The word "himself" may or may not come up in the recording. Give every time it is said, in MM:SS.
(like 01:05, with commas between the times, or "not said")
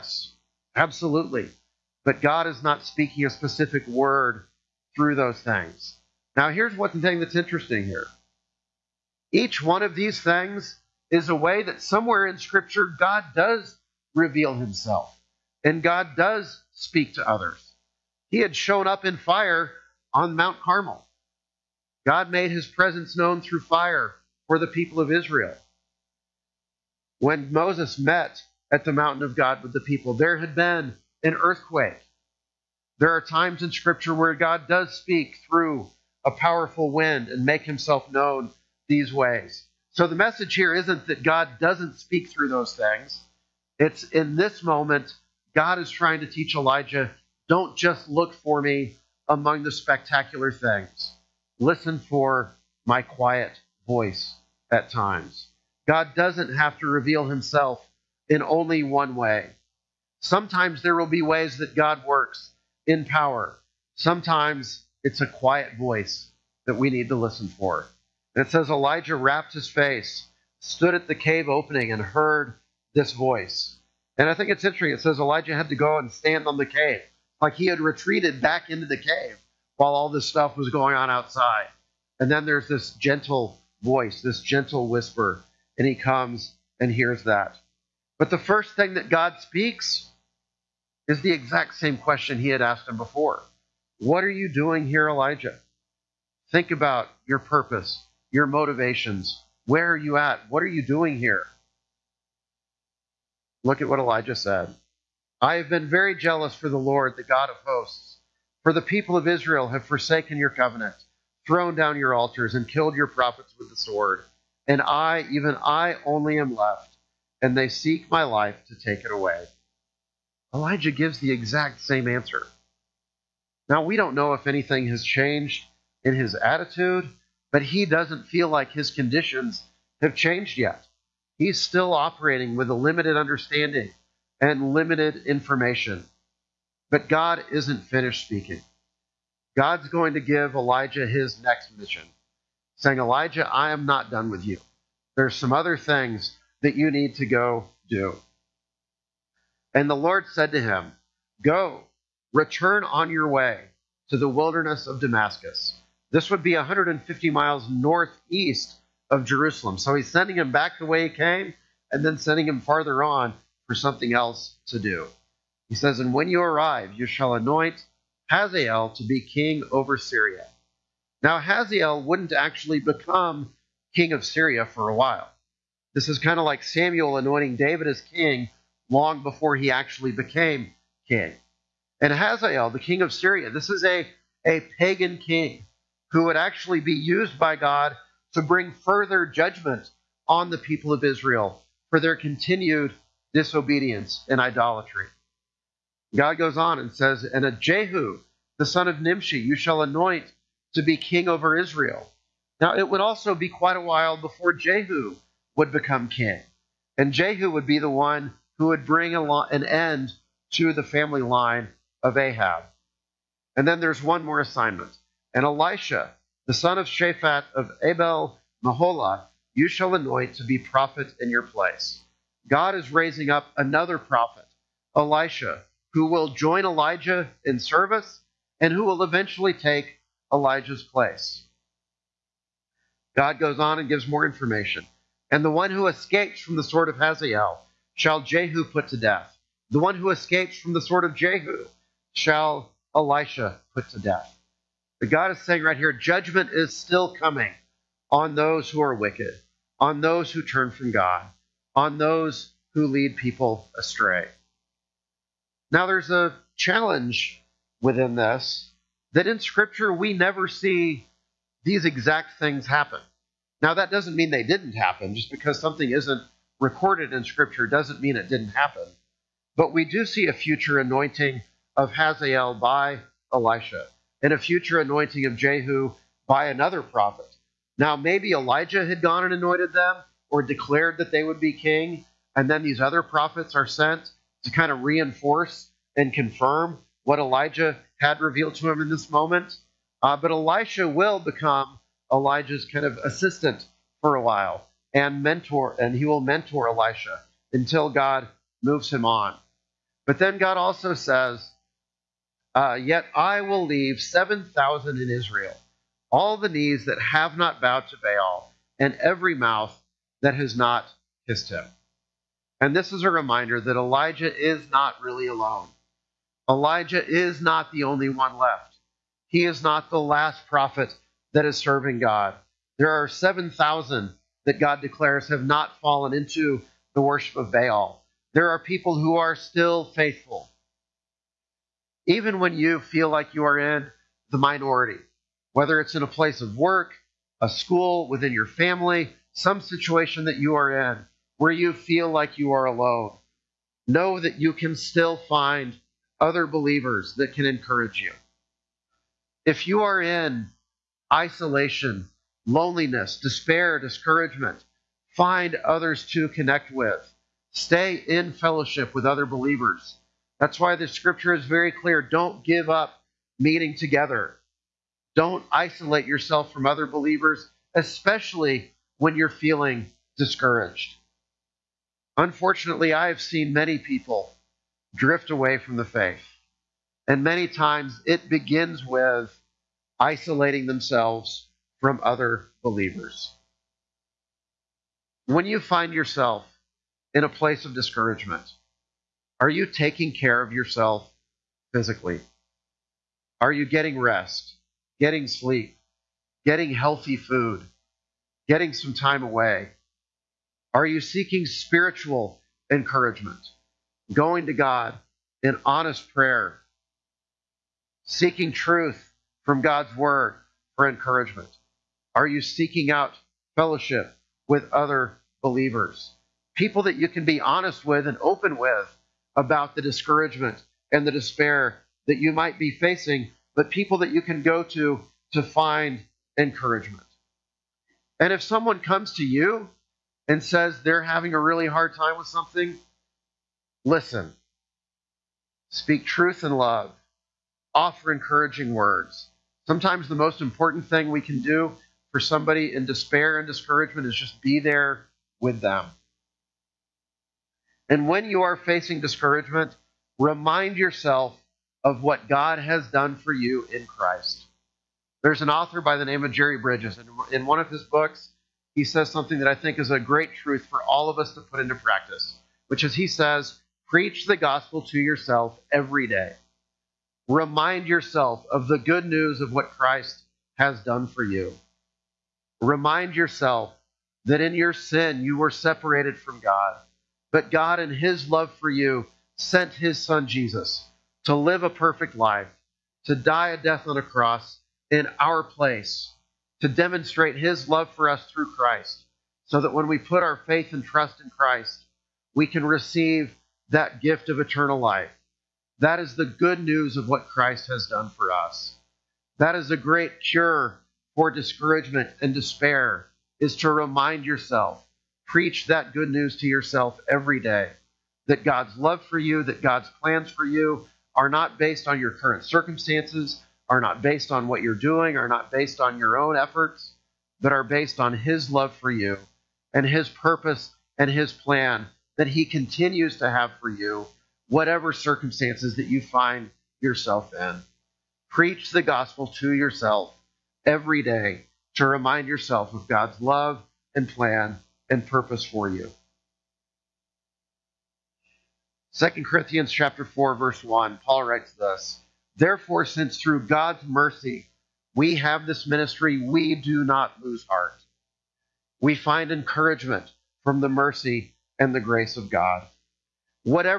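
00:14, 00:37, 00:57.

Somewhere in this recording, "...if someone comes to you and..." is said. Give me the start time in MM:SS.
07:08.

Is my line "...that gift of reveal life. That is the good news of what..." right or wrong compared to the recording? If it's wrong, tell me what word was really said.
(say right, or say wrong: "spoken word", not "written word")
wrong: "eternal", not "reveal".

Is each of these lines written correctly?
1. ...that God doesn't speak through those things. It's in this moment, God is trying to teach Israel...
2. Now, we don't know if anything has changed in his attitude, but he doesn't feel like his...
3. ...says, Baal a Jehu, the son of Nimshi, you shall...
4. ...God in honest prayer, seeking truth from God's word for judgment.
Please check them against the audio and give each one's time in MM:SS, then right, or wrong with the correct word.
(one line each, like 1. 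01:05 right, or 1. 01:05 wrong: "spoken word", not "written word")
1. 00:41 wrong: "Elijah", not "Israel"
2. 02:03 right
3. 03:16 wrong: "And", not "Baal"
4. 06:44 wrong: "encouragement", not "judgment".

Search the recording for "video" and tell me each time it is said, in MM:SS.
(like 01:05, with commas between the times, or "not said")
not said.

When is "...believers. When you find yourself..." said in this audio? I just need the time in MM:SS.
06:22.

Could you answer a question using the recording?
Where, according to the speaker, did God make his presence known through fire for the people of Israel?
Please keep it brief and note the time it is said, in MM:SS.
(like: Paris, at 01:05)
Mount Carmel, at 00:20.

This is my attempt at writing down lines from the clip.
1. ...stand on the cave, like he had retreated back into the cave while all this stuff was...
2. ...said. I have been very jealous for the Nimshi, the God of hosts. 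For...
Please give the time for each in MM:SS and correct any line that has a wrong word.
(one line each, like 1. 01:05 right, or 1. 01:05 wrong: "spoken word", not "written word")
1. 01:16 right
2. 01:44 wrong: "Lord", not "Nimshi".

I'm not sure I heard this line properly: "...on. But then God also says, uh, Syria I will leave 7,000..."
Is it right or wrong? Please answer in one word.
wrong.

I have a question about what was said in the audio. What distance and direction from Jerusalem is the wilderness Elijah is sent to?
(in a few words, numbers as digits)
150 miles northeast.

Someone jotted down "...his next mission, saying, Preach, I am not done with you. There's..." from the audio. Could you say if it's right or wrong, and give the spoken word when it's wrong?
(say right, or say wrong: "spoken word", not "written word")
wrong: "Elijah", not "Preach".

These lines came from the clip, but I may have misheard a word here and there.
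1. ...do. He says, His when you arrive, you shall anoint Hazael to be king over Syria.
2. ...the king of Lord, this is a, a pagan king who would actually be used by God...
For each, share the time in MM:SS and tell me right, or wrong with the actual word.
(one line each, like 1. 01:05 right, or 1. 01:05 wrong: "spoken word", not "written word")
1. 02:44 wrong: "And", not "His"
2. 03:02 wrong: "Syria", not "Lord".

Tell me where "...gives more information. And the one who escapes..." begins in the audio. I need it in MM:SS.
03:53.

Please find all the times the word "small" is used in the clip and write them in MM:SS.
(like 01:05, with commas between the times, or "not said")
not said.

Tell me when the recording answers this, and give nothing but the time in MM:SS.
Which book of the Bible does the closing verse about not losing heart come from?
08:58.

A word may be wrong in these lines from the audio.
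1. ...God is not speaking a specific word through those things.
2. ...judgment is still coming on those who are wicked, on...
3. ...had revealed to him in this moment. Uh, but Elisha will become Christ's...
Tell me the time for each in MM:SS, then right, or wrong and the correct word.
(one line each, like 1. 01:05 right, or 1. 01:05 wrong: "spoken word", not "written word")
1. 00:02 right
2. 04:05 right
3. 04:47 wrong: "Elijah", not "Christ".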